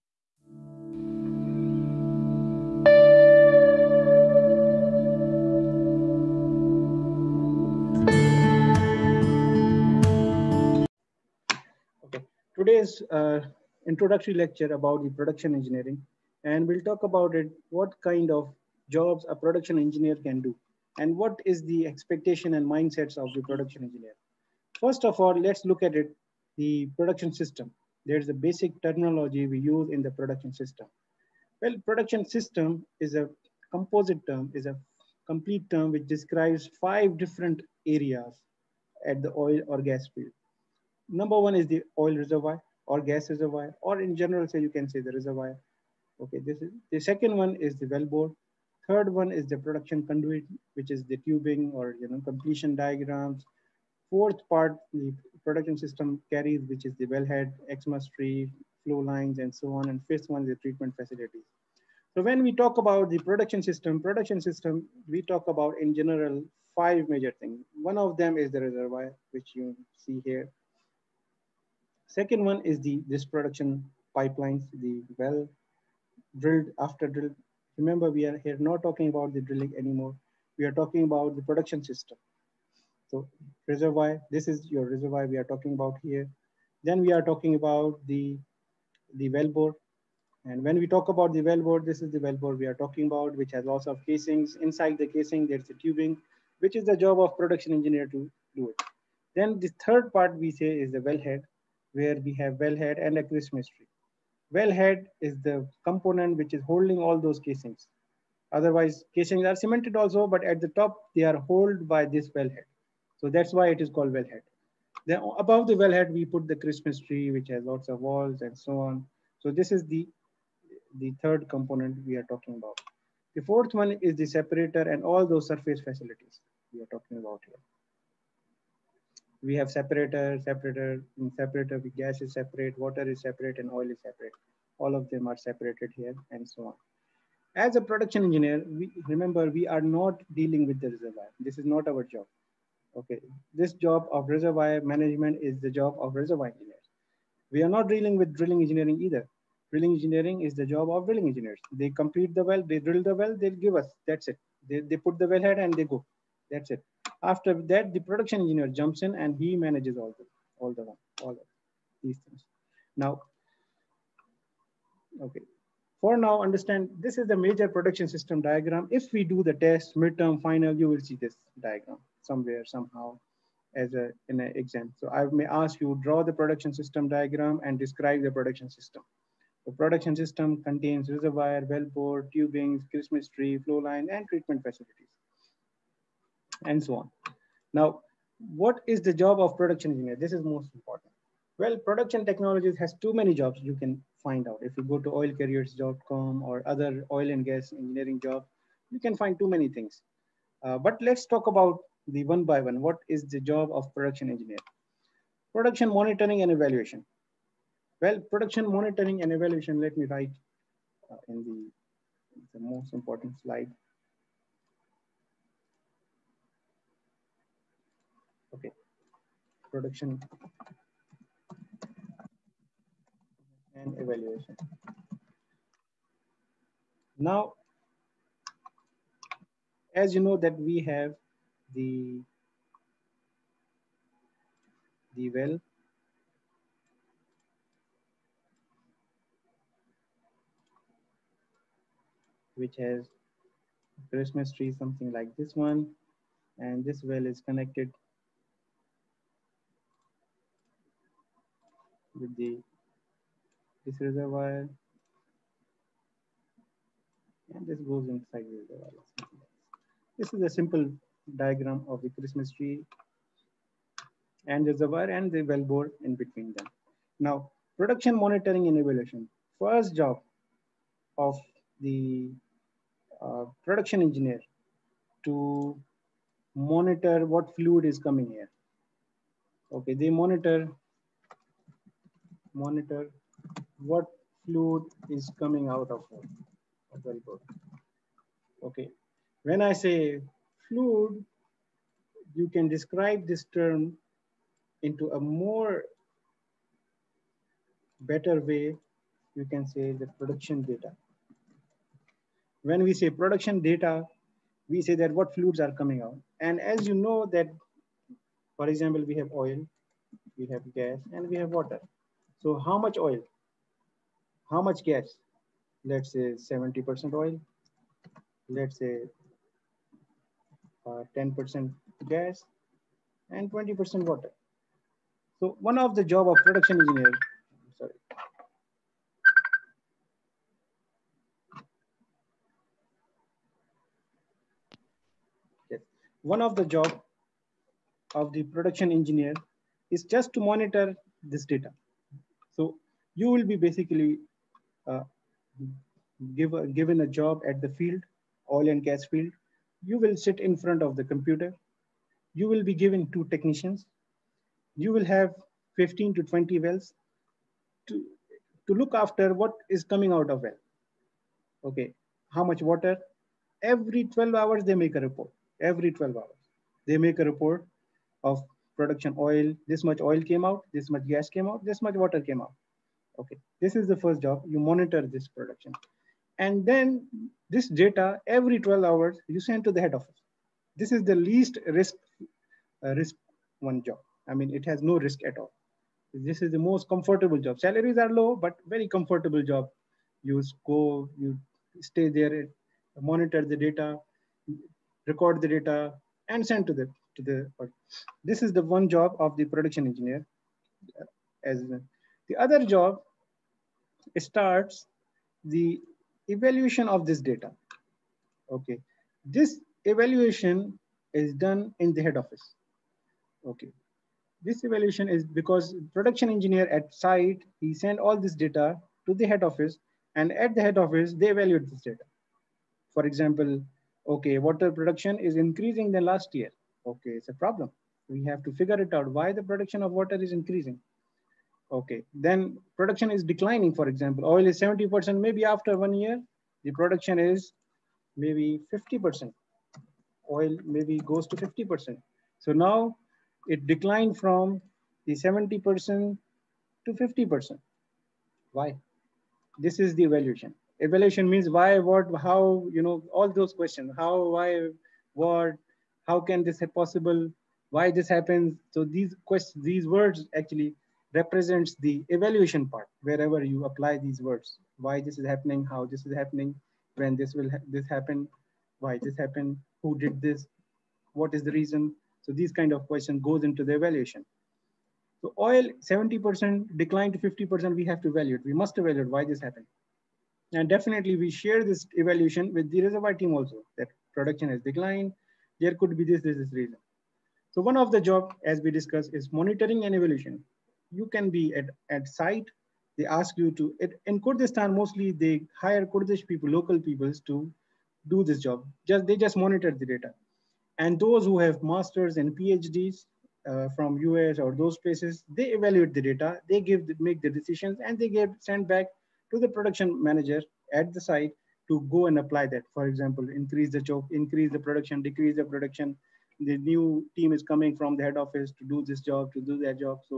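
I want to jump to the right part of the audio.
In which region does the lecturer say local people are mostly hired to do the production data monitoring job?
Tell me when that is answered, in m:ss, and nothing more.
8:14.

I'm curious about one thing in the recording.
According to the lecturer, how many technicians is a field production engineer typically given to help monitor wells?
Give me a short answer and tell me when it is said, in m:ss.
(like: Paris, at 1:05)
2, at 5:53.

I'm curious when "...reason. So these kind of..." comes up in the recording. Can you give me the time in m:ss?
7:51.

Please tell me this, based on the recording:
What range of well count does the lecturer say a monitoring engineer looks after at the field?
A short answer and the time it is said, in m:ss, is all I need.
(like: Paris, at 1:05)
15 to 20, at 5:55.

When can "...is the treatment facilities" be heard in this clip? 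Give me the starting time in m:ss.
1:00.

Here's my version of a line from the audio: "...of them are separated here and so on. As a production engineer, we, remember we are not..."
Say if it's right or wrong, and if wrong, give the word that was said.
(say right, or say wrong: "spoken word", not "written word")
right.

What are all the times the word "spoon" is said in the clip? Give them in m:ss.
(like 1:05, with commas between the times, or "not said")
not said.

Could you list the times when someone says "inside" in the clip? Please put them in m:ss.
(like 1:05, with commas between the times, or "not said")
1:34, 4:18.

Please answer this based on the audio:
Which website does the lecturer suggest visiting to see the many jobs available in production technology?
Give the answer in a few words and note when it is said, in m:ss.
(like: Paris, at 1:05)
oilcareers.com, at 3:15.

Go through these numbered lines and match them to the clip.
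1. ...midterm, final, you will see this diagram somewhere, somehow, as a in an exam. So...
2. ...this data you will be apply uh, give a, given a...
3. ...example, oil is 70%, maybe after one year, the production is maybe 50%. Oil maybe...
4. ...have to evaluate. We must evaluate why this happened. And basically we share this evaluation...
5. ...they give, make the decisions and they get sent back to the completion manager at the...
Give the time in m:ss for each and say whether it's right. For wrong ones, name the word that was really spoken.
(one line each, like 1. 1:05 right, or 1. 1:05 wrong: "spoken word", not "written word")
1. 2:49 right
2. 5:41 wrong: "basically", not "apply"
3. 7:13 right
4. 7:57 wrong: "definitely", not "basically"
5. 8:26 wrong: "production", not "completion".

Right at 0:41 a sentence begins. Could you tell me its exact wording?
Number one is the oil reservoir or gas reservoir, or in general, say you can say the reservoir.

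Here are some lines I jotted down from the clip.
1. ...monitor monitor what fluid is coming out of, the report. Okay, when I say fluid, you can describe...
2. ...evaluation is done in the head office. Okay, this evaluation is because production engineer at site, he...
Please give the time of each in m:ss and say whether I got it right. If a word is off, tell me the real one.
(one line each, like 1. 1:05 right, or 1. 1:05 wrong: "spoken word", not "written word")
1. 4:40 right
2. 6:49 right.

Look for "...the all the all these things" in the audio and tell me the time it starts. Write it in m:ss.
2:40.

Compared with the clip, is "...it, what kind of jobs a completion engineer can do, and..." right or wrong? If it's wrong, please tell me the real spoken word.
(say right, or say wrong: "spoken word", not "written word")
wrong: "production", not "completion".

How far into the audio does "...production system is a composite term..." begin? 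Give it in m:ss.
0:31.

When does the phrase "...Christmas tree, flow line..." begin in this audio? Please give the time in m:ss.
3:02.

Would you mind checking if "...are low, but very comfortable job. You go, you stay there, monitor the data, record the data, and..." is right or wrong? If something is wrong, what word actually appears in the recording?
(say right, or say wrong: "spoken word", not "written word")
right.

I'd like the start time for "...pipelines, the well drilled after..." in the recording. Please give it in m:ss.
1:14.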